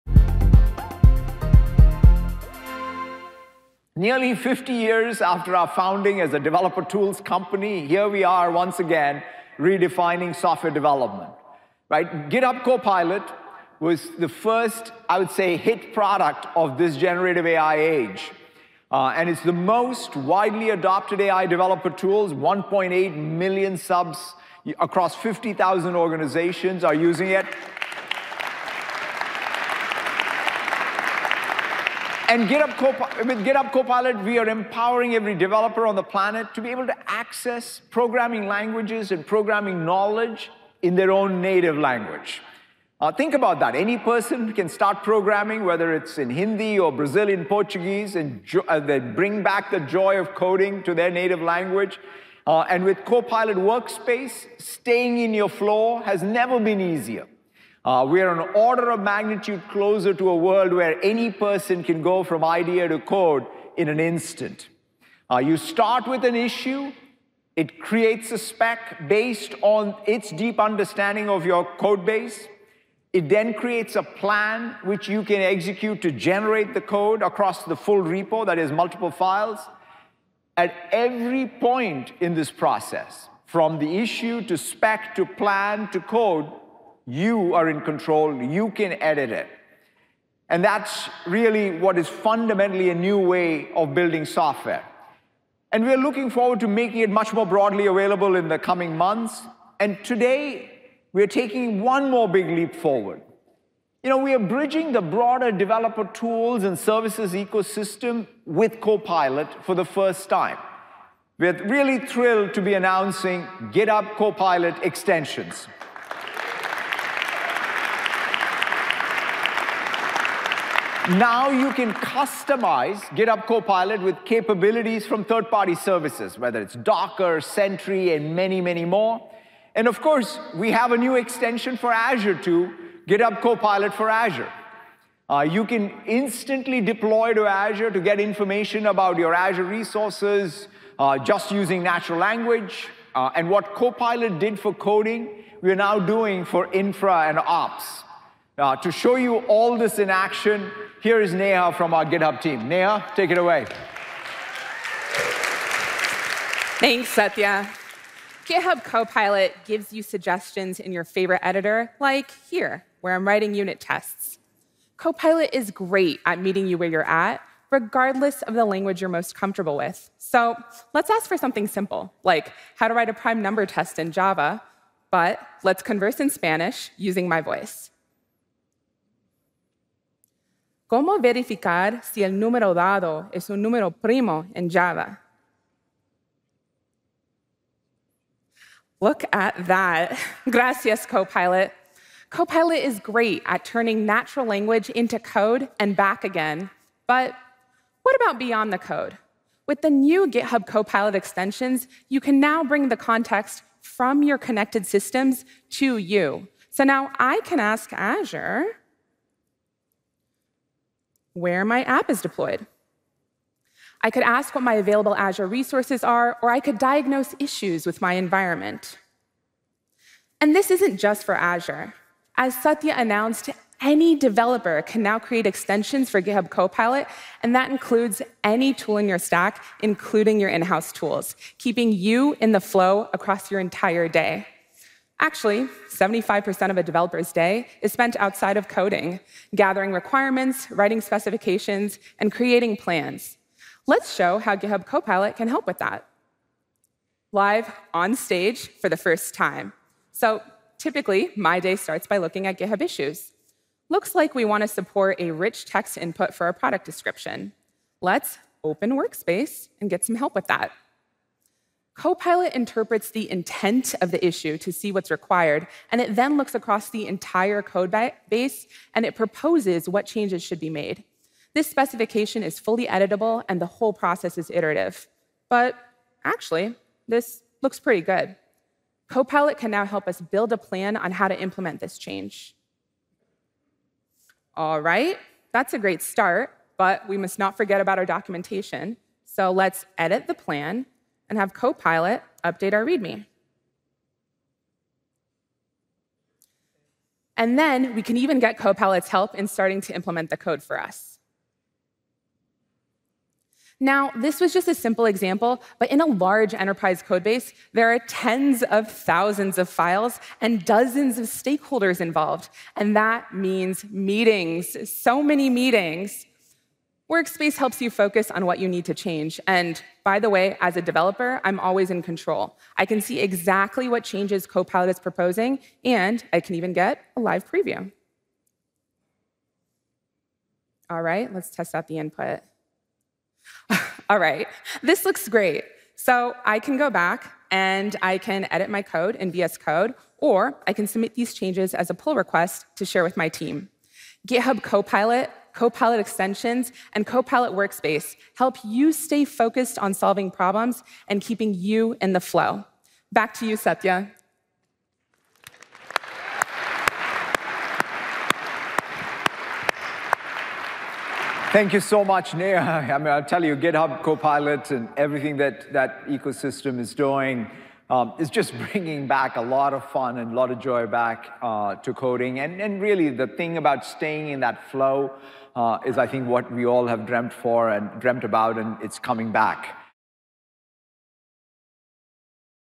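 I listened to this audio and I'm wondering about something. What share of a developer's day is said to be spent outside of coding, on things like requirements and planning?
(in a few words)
75%.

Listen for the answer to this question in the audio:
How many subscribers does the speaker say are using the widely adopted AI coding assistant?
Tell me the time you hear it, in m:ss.
0:22.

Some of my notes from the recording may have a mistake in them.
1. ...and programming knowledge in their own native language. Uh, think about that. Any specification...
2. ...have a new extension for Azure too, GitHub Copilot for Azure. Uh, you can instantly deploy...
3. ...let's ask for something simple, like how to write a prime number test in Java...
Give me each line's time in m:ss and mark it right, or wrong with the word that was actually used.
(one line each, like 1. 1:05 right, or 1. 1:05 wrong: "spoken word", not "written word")
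1. 0:39 wrong: "person", not "specification"
2. 2:10 right
3. 2:50 right.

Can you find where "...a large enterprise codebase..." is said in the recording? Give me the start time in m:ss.
5:06.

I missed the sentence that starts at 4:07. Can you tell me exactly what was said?
Live on stage for the first time.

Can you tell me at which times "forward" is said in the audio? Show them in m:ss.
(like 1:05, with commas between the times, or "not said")
1:36, 1:42.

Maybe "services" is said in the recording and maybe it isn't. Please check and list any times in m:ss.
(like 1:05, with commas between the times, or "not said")
1:46, 2:05.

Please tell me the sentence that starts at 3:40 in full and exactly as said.
And this isn't just for Azure.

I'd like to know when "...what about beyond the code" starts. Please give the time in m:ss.
3:18.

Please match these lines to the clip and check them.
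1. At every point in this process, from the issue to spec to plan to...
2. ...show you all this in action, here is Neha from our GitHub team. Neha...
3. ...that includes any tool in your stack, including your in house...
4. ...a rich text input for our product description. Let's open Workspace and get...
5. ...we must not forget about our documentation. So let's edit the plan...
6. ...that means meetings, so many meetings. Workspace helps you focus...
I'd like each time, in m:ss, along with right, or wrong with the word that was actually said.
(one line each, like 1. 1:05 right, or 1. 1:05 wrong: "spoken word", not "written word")
1. 1:20 right
2. 2:28 right
3. 3:47 right
4. 4:15 right
5. 4:47 right
6. 5:12 right.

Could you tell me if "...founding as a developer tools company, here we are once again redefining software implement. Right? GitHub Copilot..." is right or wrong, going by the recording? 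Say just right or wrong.
wrong.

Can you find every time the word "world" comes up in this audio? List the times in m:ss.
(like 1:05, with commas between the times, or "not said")
1:00.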